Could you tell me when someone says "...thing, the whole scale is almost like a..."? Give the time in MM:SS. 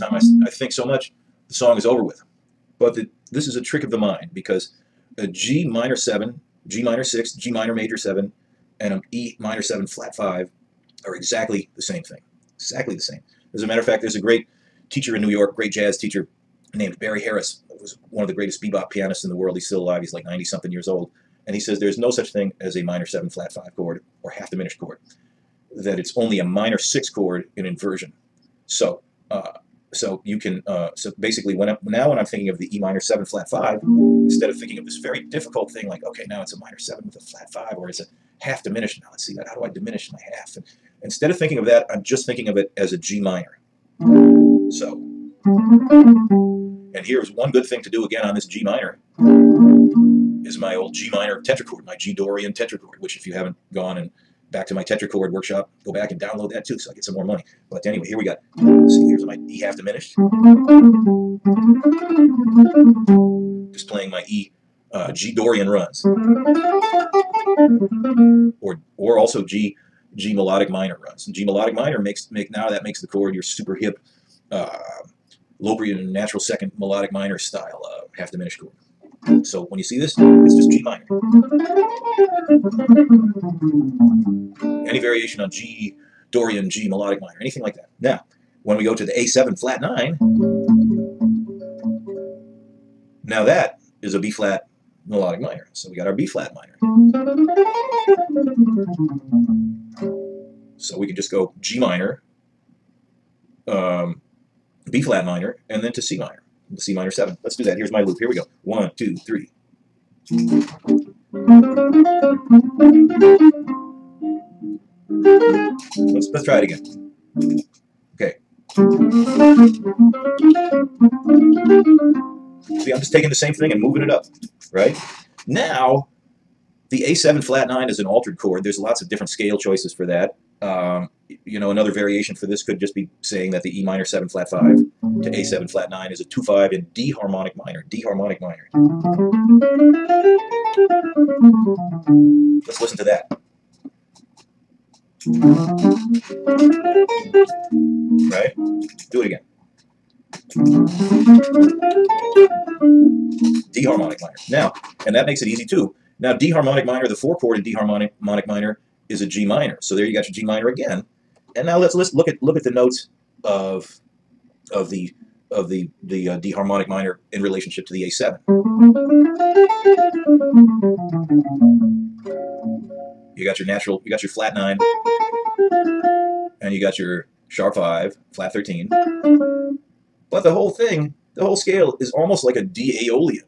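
03:00.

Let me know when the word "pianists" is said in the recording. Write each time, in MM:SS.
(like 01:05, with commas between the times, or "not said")
00:18.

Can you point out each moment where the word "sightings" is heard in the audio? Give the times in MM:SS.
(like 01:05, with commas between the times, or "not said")
not said.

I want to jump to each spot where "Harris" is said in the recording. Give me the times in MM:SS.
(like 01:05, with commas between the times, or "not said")
00:17.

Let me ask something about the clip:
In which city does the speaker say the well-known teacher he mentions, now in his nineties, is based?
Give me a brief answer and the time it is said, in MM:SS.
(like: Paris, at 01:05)
New York, at 00:15.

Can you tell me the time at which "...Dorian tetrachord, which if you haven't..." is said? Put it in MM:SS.
00:52.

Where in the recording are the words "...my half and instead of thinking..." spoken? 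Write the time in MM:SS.
00:40.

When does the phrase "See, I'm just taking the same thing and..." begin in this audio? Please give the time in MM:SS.
02:02.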